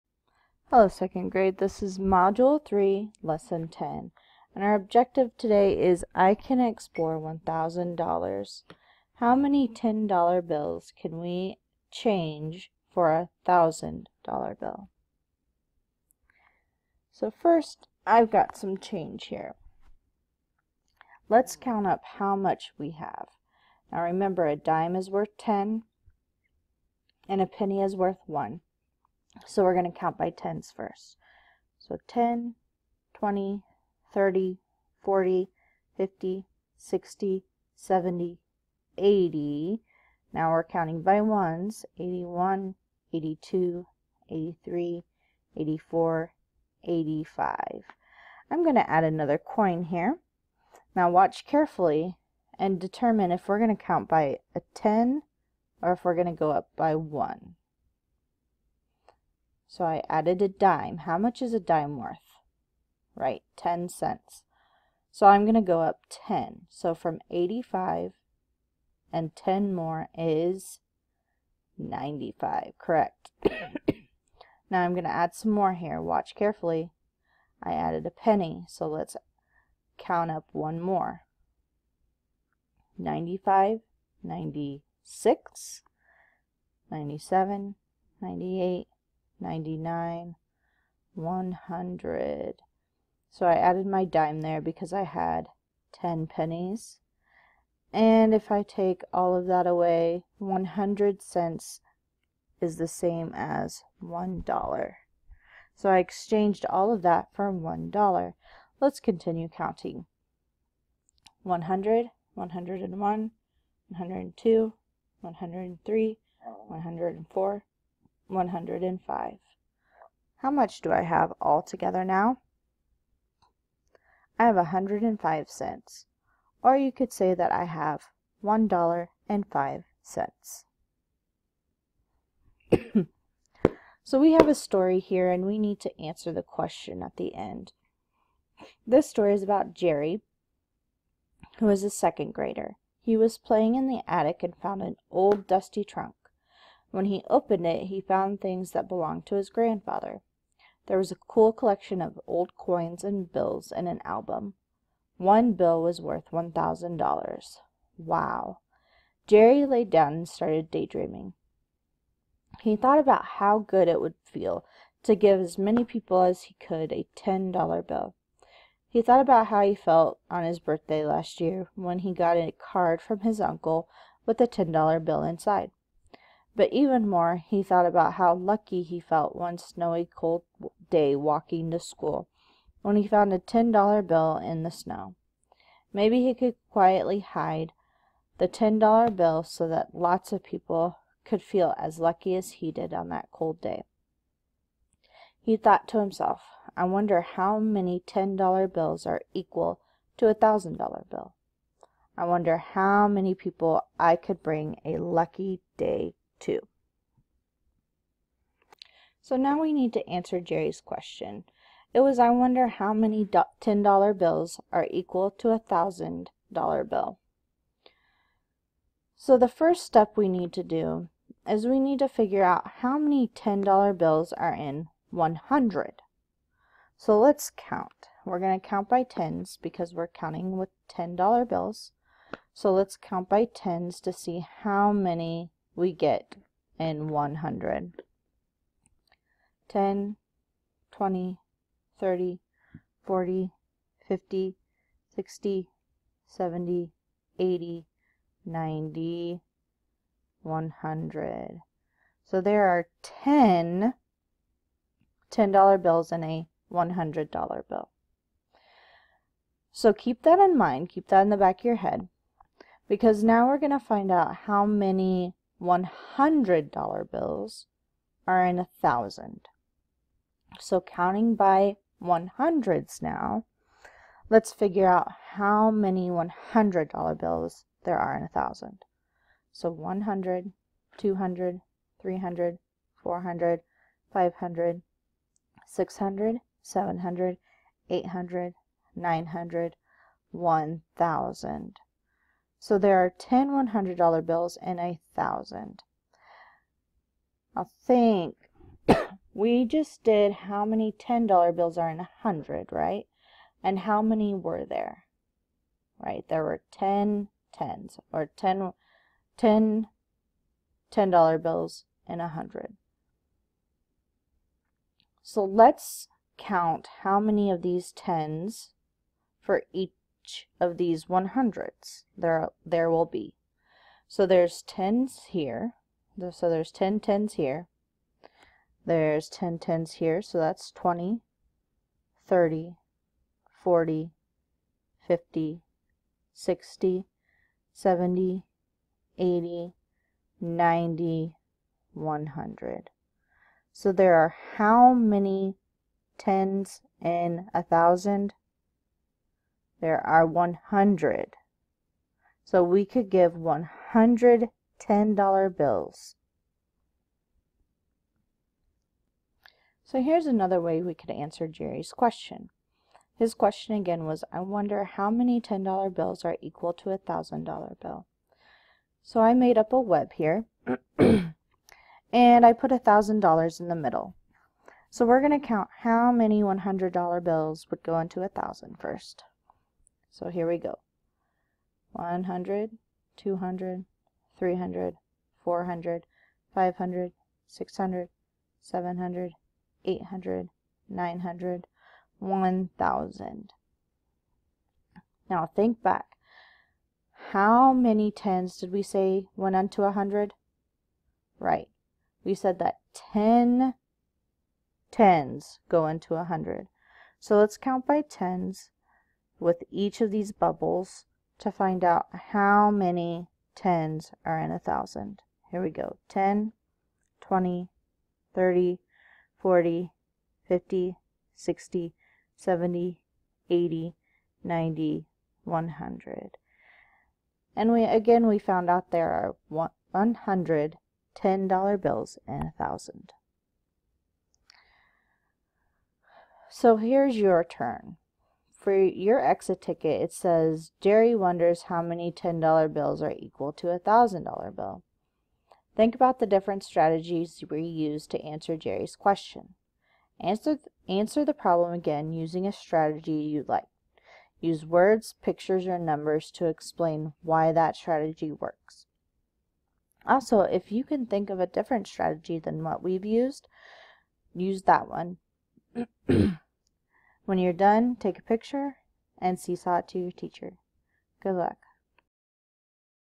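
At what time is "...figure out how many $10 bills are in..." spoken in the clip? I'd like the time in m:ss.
3:42.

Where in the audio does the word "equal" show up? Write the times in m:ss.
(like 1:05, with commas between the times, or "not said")
3:19, 3:34, 6:06, 7:23.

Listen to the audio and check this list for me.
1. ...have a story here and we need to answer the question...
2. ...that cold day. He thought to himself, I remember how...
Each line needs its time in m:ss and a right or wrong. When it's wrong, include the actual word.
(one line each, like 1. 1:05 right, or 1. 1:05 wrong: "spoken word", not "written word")
1. 2:14 right
2. 3:13 wrong: "wonder", not "remember".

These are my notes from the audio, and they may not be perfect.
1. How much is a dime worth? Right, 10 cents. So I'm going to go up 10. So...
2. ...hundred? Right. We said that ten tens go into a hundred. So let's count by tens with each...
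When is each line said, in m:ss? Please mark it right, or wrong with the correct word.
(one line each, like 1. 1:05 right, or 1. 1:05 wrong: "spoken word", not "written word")
1. 1:01 right
2. 6:39 right.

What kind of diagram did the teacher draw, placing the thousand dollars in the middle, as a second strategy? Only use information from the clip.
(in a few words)
a web.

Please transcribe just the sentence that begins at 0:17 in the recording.
So first, I've got some change here.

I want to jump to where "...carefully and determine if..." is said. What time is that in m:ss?
0:51.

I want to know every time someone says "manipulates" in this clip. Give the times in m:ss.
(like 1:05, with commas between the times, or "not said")
not said.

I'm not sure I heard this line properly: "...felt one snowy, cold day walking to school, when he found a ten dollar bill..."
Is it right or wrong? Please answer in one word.
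right.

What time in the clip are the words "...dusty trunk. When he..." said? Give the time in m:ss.
2:25.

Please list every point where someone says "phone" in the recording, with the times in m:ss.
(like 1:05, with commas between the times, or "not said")
not said.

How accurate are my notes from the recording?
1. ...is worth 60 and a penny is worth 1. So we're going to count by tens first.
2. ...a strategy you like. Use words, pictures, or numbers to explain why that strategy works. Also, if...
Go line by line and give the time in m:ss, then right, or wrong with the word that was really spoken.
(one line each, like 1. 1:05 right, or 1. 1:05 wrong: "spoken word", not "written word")
1. 0:24 wrong: "10", not "60"
2. 7:32 right.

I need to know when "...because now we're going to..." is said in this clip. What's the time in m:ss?
4:22.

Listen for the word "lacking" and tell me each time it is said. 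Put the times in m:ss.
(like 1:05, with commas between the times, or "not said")
not said.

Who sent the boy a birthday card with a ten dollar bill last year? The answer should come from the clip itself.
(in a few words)
his uncle.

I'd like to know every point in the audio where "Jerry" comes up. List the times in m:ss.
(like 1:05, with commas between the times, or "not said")
2:19, 2:39, 3:30, 6:01, 7:20, 7:28.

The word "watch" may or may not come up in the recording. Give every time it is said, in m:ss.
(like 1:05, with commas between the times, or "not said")
0:51, 1:16.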